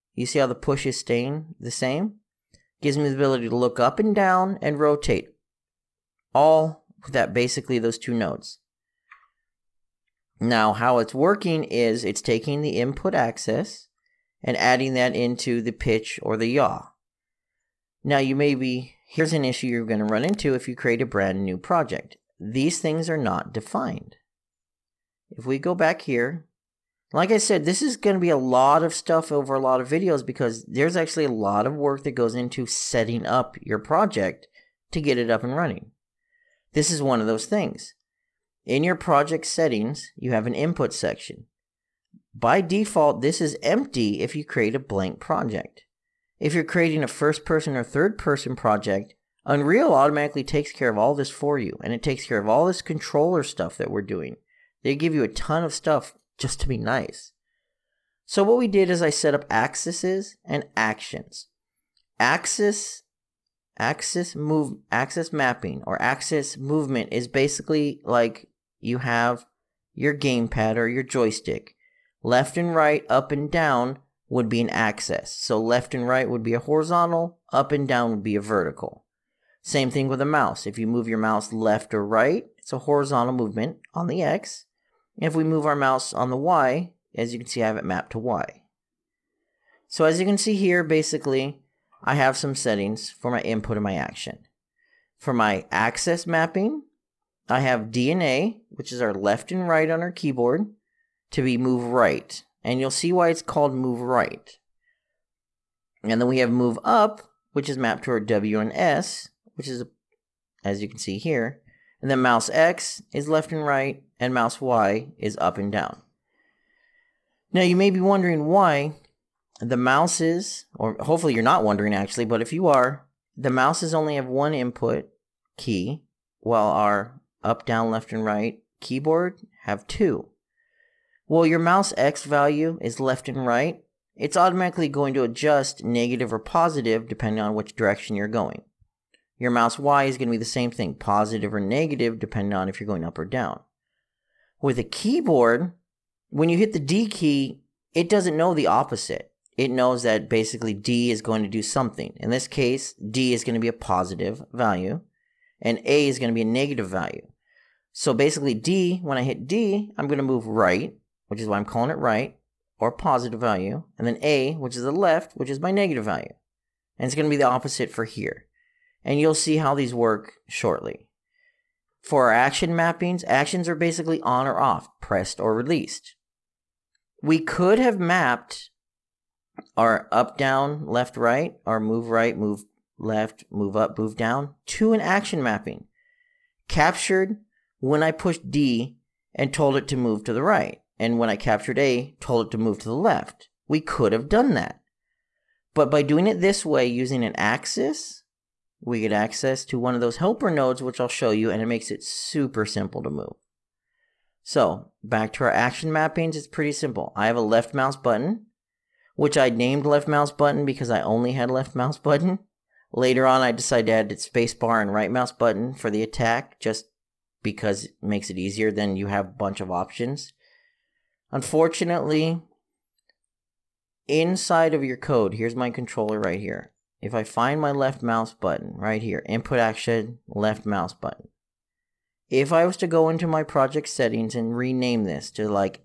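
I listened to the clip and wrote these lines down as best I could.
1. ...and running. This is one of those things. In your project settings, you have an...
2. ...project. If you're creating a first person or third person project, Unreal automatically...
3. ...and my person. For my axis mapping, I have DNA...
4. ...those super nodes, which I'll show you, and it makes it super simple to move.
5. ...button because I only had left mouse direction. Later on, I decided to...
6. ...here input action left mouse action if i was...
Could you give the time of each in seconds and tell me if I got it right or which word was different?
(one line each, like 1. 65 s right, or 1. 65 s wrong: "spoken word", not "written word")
1. 35 s right
2. 45 s right
3. 93 s wrong: "action", not "person"
4. 200 s wrong: "helper", not "super"
5. 210 s wrong: "button", not "direction"
6. 229 s wrong: "button", not "action".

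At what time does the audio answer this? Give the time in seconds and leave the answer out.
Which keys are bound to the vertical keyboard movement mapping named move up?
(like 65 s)
108 s.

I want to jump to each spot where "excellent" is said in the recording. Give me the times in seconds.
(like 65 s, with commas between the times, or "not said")
not said.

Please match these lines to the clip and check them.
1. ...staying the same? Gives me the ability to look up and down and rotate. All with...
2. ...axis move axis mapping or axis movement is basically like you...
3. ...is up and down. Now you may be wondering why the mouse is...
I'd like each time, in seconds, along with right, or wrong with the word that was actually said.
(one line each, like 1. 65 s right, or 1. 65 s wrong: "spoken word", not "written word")
1. 0 s right
2. 63 s right
3. 115 s right.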